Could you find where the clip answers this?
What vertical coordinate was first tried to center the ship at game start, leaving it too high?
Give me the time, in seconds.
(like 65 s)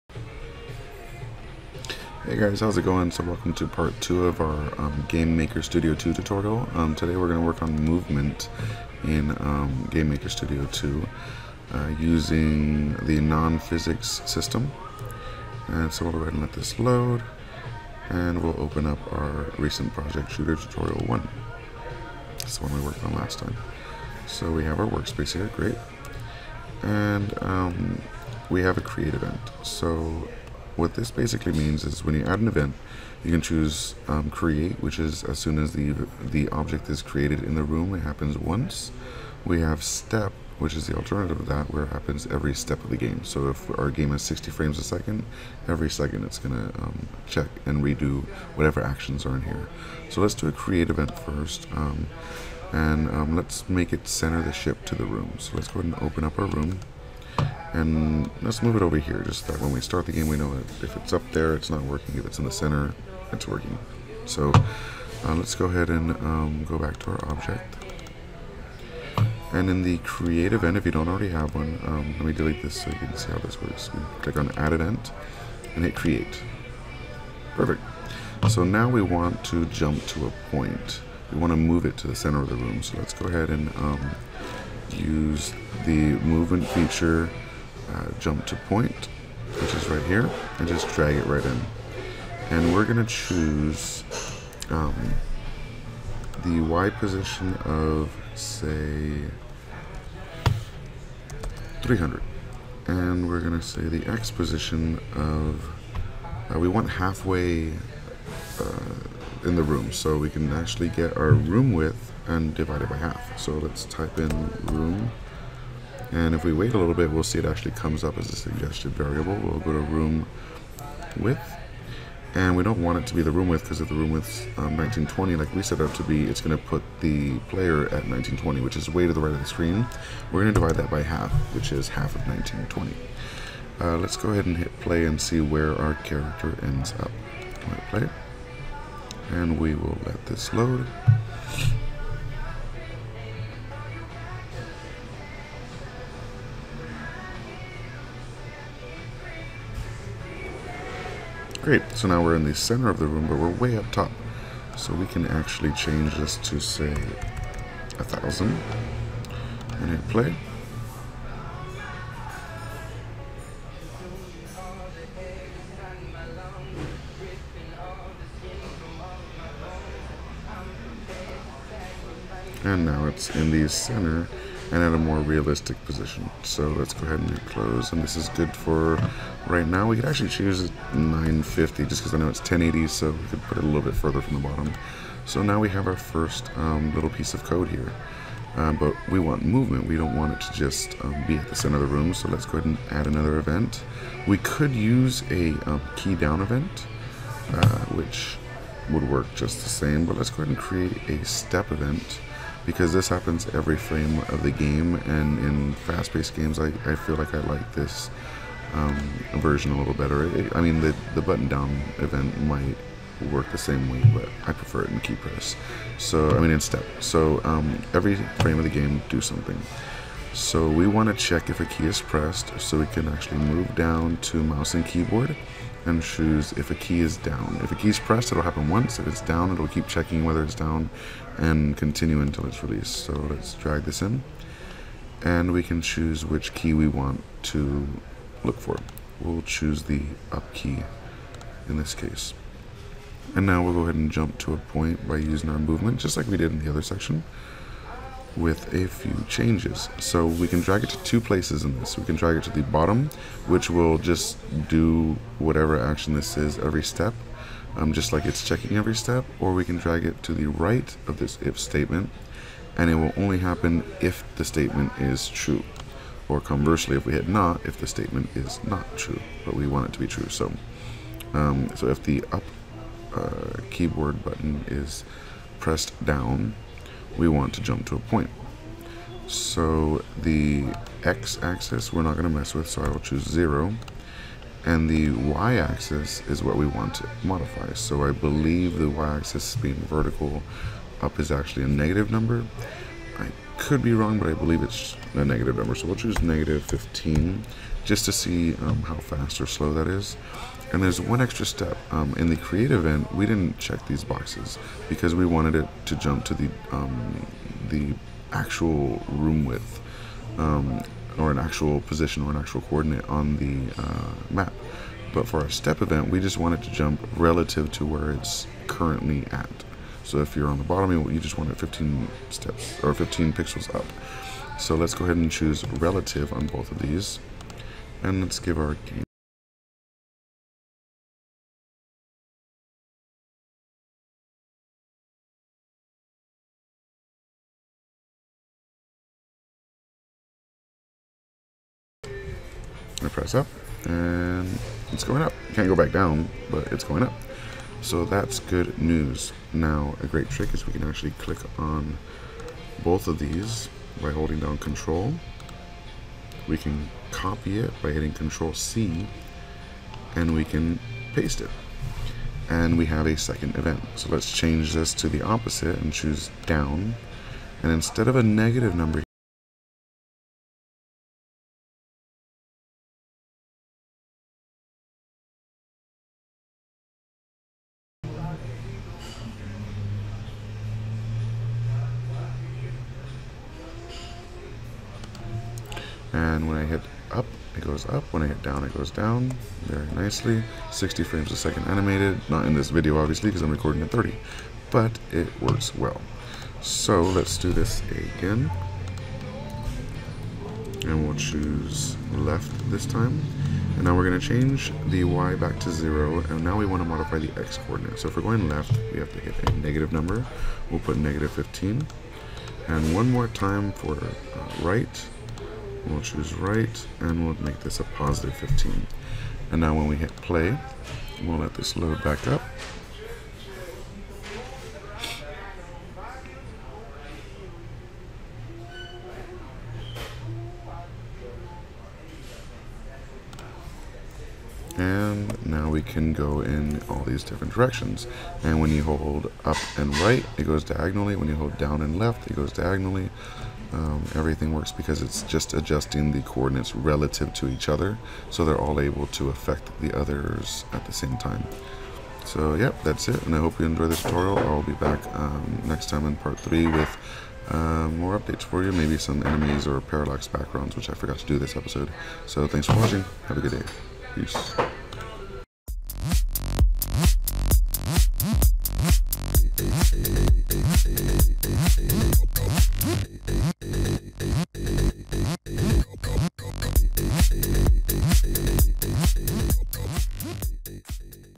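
101 s.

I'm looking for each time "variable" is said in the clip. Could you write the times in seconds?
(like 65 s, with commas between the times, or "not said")
118 s.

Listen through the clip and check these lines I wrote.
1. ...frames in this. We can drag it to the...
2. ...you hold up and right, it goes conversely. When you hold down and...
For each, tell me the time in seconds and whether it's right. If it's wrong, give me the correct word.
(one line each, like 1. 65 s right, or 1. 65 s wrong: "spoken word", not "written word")
1. 251 s wrong: "places", not "frames"
2. 438 s wrong: "diagonally", not "conversely".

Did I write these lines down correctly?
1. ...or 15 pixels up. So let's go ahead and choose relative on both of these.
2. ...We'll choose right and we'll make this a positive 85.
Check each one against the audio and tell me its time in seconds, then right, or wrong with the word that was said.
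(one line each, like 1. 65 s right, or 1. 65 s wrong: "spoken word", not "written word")
1. 322 s right
2. 415 s wrong: "15", not "85".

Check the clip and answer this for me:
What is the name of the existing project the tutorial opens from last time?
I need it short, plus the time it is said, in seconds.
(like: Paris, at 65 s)
shooter tutorial 1, at 20 s.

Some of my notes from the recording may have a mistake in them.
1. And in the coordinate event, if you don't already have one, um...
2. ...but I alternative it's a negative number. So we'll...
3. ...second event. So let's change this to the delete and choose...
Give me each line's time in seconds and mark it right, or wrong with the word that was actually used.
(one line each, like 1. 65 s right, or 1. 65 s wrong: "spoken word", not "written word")
1. 69 s wrong: "create", not "coordinate"
2. 294 s wrong: "believe", not "alternative"
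3. 363 s wrong: "opposite", not "delete".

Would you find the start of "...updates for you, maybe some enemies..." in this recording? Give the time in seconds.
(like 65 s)
458 s.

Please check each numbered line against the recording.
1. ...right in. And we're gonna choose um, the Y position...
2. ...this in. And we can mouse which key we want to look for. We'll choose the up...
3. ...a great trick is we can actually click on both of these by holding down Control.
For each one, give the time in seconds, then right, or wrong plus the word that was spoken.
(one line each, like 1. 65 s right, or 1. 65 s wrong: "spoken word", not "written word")
1. 91 s right
2. 233 s wrong: "choose", not "mouse"
3. 350 s right.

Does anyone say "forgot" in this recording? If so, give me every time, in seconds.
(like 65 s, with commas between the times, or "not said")
460 s.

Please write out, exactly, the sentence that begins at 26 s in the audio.
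And um, we have a create event.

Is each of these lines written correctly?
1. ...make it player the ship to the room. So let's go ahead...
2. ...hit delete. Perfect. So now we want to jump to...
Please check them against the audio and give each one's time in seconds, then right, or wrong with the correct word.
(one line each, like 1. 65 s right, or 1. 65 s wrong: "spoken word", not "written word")
1. 53 s wrong: "center", not "player"
2. 75 s wrong: "create", not "delete".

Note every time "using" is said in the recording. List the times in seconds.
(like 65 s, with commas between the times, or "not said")
11 s, 245 s.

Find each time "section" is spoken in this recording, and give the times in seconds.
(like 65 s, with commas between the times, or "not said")
246 s.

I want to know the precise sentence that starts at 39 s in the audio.
We have step, which is the alternative of that, where it happens every step of the game.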